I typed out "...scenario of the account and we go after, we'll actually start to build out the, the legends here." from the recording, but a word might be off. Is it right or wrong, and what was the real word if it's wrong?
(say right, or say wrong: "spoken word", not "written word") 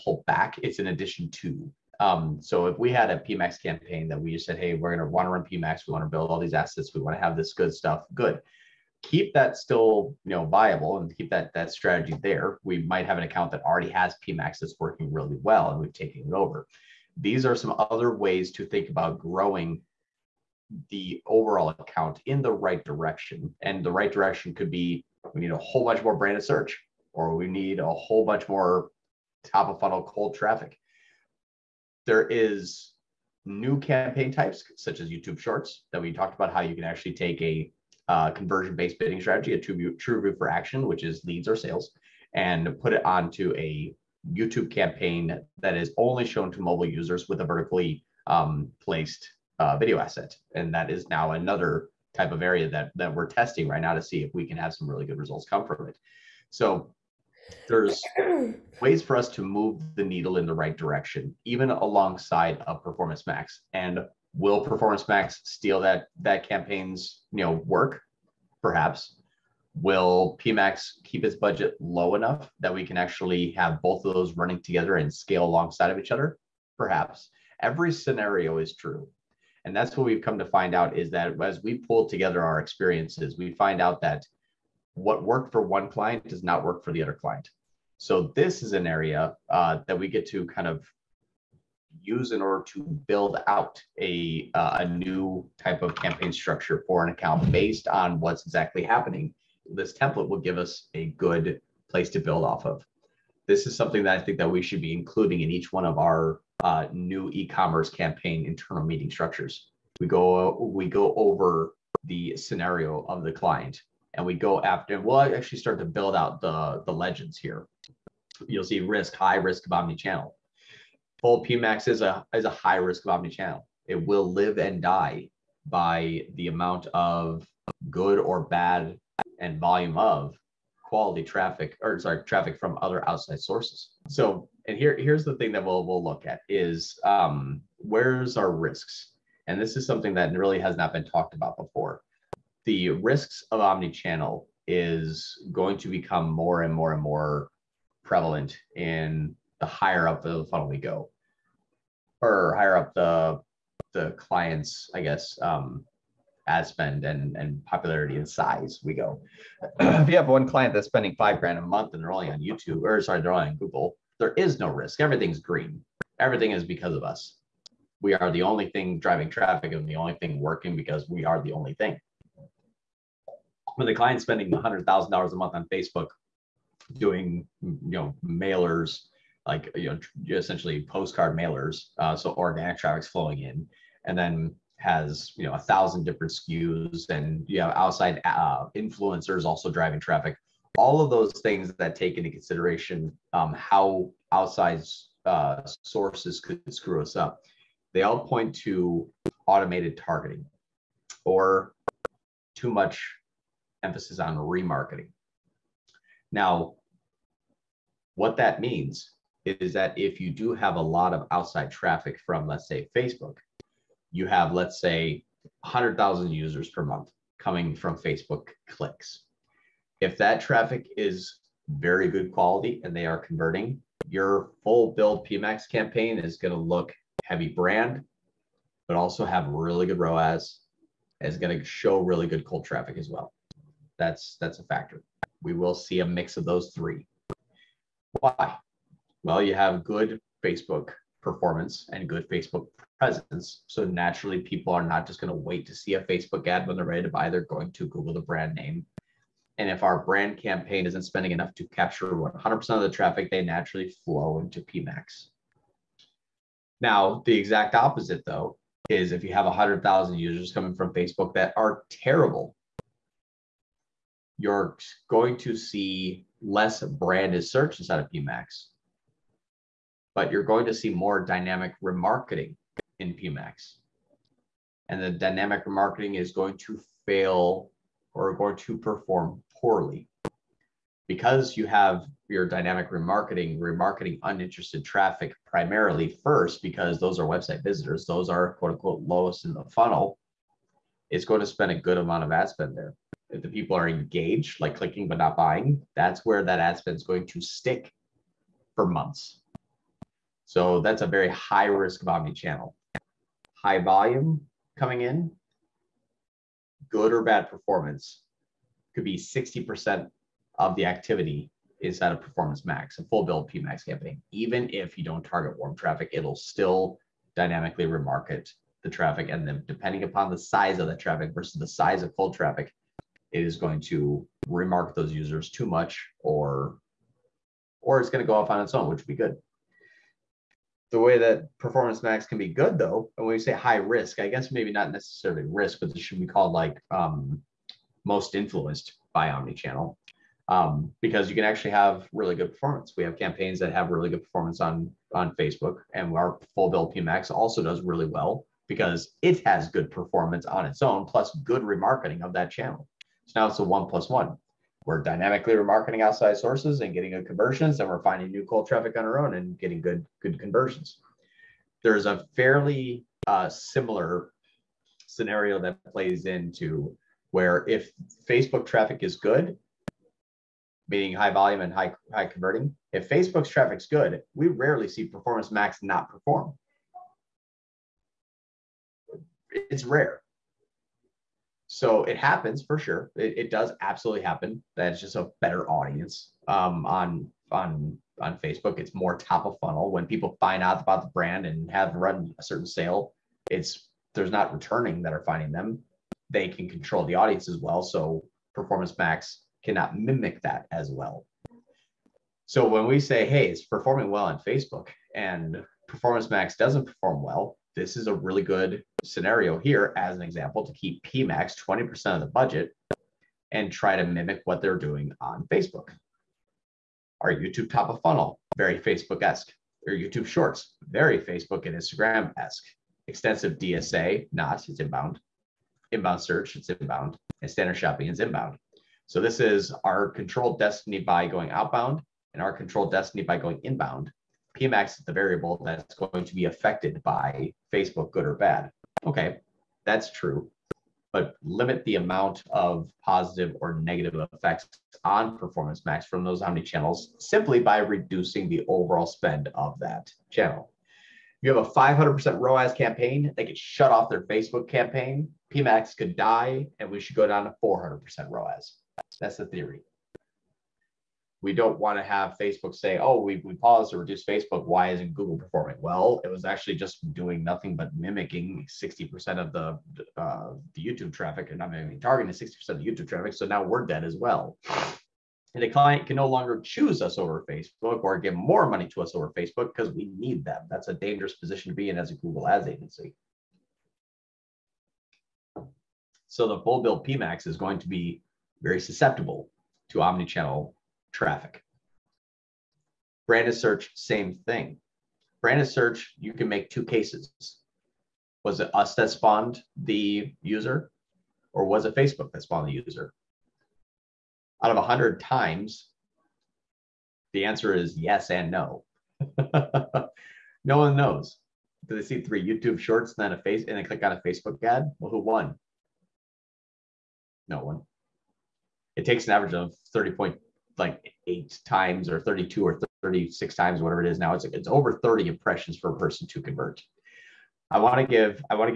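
wrong: "client", not "account".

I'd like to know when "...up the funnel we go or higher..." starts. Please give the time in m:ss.
2:30.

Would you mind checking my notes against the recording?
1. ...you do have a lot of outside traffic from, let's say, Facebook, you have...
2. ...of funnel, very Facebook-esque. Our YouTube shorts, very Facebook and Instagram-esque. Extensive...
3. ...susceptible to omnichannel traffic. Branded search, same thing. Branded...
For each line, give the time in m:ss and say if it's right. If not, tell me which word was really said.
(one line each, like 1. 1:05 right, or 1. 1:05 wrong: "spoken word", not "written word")
1. 3:30 right
2. 6:57 right
3. 8:08 right.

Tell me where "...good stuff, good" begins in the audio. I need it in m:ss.
0:07.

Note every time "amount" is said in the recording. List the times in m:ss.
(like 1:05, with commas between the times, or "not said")
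2:06, 4:51, 7:21.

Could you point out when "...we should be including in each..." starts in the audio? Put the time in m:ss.
1:44.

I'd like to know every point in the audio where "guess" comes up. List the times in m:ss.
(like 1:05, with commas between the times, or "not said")
2:34, 5:34.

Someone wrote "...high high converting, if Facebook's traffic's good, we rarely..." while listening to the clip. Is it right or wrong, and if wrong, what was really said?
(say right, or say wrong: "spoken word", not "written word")
right.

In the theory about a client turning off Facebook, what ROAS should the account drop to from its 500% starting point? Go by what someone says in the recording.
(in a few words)
400%.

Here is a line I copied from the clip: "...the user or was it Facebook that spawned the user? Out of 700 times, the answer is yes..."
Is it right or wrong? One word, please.
wrong.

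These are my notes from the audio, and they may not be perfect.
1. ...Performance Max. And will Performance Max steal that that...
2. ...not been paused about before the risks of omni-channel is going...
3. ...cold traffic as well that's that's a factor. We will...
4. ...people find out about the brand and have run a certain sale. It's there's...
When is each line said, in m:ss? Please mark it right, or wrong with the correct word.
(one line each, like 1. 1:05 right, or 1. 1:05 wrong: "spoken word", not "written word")
1. 1:02 right
2. 2:20 wrong: "talked", not "paused"
3. 3:52 right
4. 6:30 right.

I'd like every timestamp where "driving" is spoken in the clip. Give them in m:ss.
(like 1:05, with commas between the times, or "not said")
2:48, 3:09.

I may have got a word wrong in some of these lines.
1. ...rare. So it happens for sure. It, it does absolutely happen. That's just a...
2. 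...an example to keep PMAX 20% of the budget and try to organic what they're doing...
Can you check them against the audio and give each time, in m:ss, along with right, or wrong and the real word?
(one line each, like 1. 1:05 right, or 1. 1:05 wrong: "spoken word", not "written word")
1. 6:19 right
2. 6:50 wrong: "mimic", not "organic".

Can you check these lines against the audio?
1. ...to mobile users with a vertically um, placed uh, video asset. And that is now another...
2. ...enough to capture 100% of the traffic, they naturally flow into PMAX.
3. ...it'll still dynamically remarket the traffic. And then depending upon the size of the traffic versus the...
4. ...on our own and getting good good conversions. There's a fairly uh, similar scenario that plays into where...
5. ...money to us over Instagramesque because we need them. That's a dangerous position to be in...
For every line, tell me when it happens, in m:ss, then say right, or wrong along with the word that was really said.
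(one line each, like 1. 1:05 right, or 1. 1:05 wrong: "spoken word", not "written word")
1. 0:46 right
2. 4:11 right
3. 5:16 right
4. 5:58 right
5. 7:58 wrong: "Facebook", not "Instagramesque".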